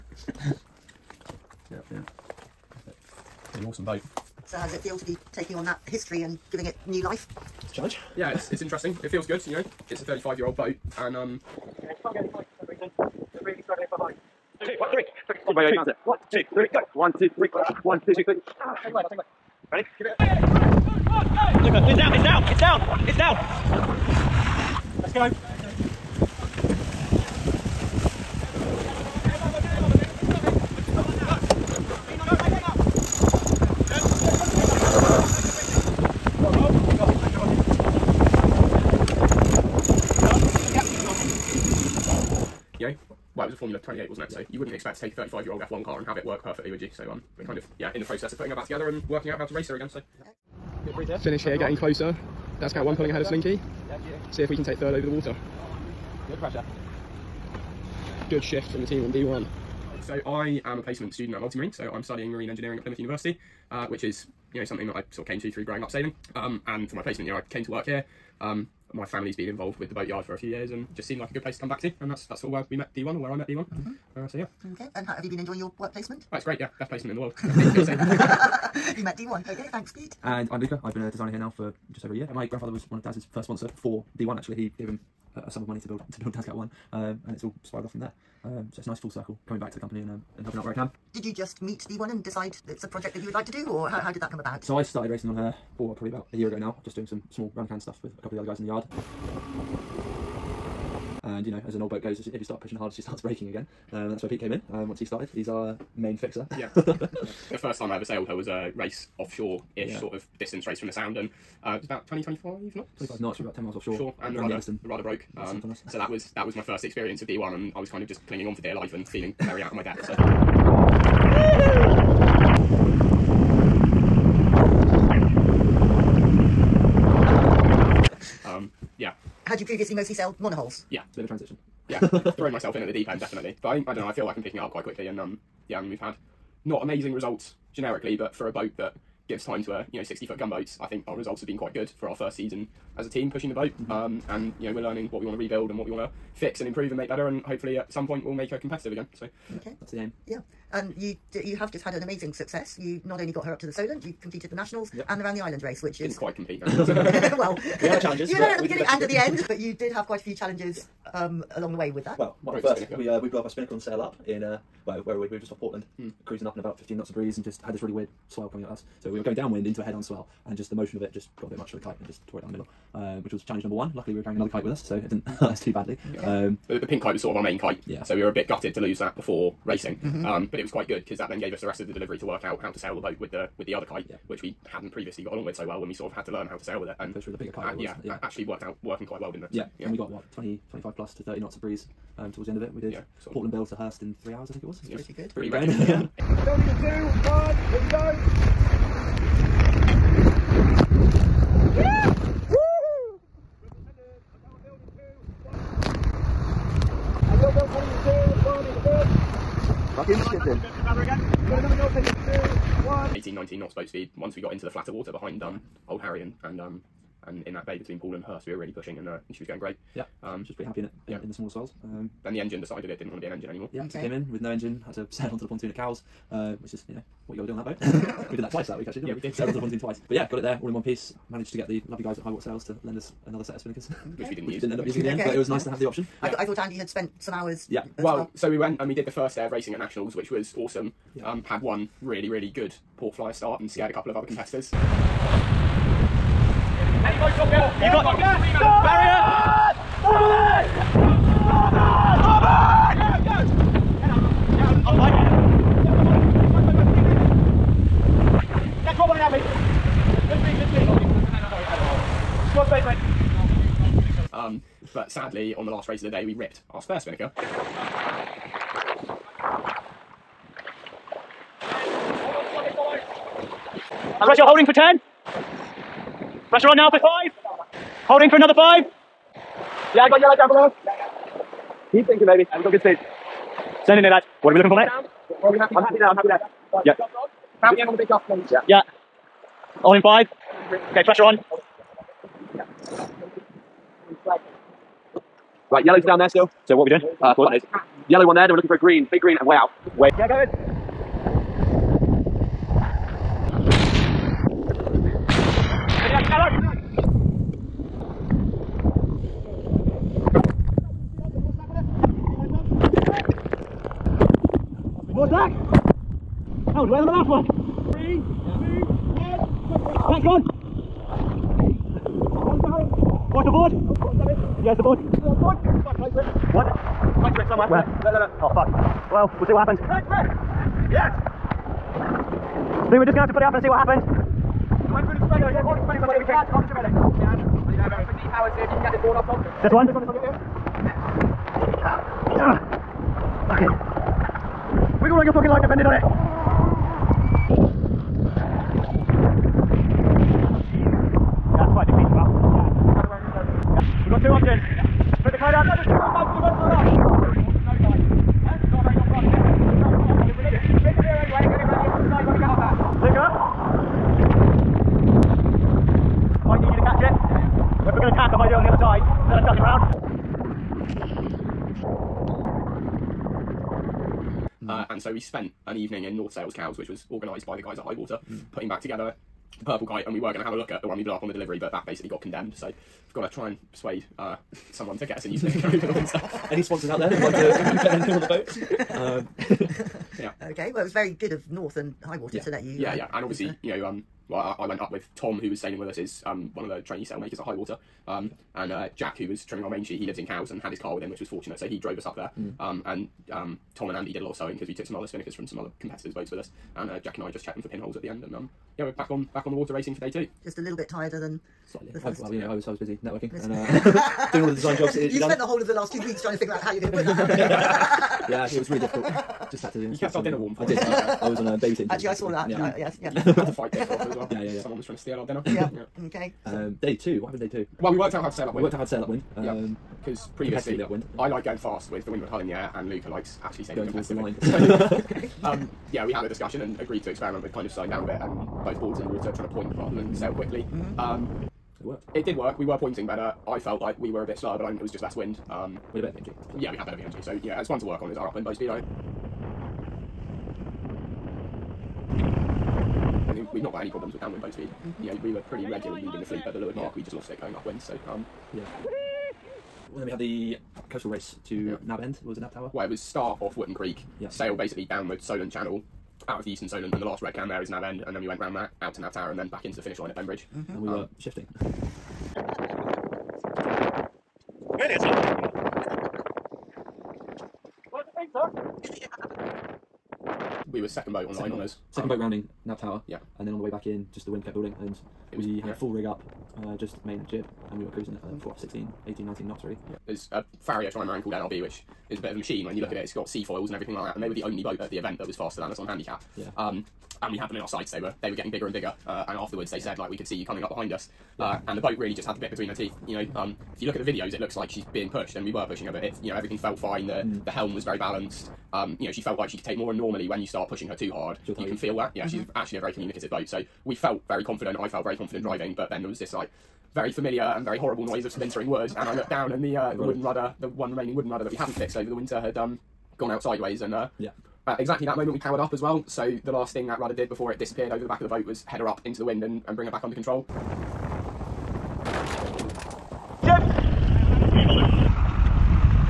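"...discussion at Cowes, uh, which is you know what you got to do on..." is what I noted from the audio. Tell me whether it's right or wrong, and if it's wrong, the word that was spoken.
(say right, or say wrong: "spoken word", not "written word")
wrong: "pontoon", not "discussion".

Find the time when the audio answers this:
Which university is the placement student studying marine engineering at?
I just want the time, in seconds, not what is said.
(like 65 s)
62 s.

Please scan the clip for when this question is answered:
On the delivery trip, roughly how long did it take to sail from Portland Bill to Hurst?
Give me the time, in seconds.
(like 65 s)
194 s.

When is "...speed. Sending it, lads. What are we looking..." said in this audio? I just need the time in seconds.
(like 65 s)
282 s.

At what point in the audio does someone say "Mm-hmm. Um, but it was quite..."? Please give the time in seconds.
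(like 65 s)
180 s.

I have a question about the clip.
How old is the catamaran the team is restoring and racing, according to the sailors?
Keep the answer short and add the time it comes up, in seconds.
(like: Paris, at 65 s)
35 years, at 10 s.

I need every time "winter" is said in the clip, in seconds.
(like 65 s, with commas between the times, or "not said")
385 s, 522 s.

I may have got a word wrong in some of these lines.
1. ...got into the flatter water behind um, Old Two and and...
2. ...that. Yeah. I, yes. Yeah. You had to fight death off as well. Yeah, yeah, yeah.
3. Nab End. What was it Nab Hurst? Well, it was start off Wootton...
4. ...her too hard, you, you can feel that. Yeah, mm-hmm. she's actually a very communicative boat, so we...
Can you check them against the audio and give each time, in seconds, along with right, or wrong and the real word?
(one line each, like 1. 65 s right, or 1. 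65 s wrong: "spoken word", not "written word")
1. 214 s wrong: "Harry", not "Two"
2. 422 s right
3. 461 s wrong: "Tower", not "Hurst"
4. 510 s right.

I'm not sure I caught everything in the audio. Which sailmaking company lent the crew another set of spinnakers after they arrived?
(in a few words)
Highwater Sails.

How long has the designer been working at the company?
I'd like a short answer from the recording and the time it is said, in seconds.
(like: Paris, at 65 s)
just over a year, at 81 s.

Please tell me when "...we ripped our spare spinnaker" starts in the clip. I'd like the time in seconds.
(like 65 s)
266 s.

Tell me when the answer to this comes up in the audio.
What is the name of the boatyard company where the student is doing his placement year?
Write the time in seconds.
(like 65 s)
61 s.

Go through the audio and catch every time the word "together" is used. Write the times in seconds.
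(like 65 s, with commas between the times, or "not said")
48 s, 378 s.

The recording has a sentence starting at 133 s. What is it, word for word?
But I think, I don't know, I feel like I'm picking it up quite quickly.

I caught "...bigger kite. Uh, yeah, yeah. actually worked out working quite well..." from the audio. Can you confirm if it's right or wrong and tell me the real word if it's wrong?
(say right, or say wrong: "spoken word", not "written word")
right.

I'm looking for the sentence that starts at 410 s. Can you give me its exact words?
Just a little bit tireder than Slightly.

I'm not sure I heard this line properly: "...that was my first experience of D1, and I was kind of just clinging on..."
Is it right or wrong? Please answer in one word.
right.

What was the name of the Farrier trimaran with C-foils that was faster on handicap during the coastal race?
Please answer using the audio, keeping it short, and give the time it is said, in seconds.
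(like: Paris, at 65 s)
NRB, at 491 s.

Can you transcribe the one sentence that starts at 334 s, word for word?
went through the spreader, uh, the the you this one.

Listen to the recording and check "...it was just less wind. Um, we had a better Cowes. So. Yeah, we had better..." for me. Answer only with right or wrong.
wrong.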